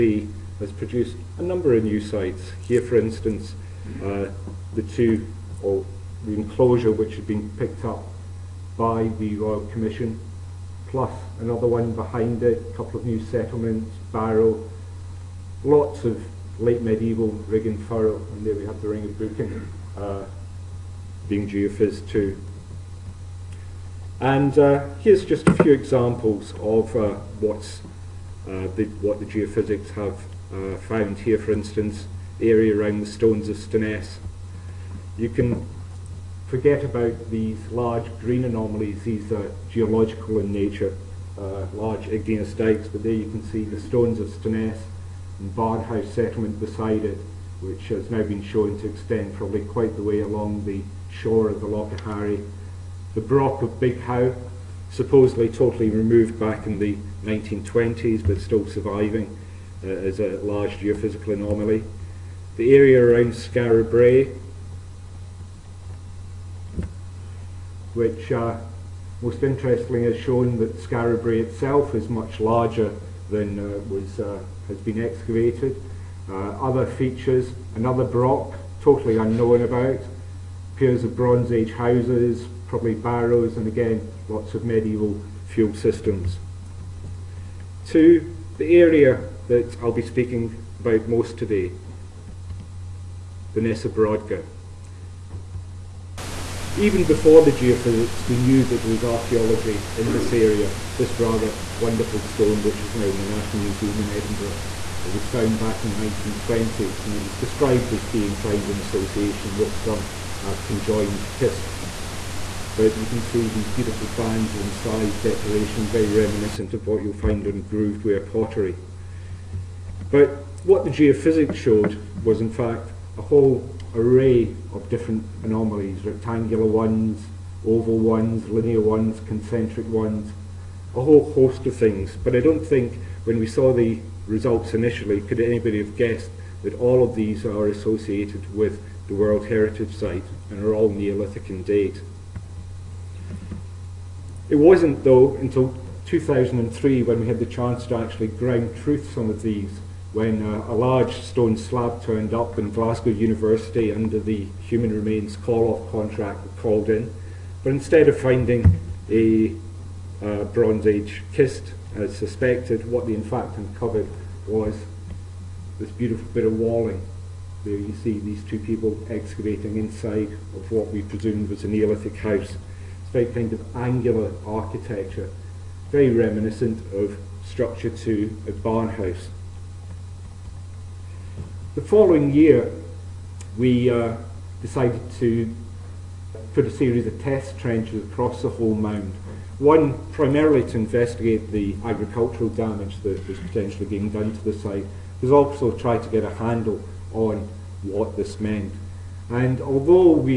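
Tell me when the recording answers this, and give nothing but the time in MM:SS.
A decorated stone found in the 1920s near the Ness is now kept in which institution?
01:43.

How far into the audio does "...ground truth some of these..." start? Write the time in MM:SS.
02:28.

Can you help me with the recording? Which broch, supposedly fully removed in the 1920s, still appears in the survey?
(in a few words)
Broch of Big Howe.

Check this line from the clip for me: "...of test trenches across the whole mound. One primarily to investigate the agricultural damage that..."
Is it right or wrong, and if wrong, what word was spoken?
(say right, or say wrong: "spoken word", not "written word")
right.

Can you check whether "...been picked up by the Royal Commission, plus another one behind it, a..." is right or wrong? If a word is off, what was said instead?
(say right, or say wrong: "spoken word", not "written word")
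right.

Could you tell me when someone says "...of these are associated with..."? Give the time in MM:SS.
02:17.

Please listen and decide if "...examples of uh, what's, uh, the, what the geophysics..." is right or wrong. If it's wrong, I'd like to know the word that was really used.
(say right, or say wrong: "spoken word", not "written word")
right.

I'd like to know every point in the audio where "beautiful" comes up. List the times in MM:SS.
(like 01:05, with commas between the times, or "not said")
01:53, 02:45.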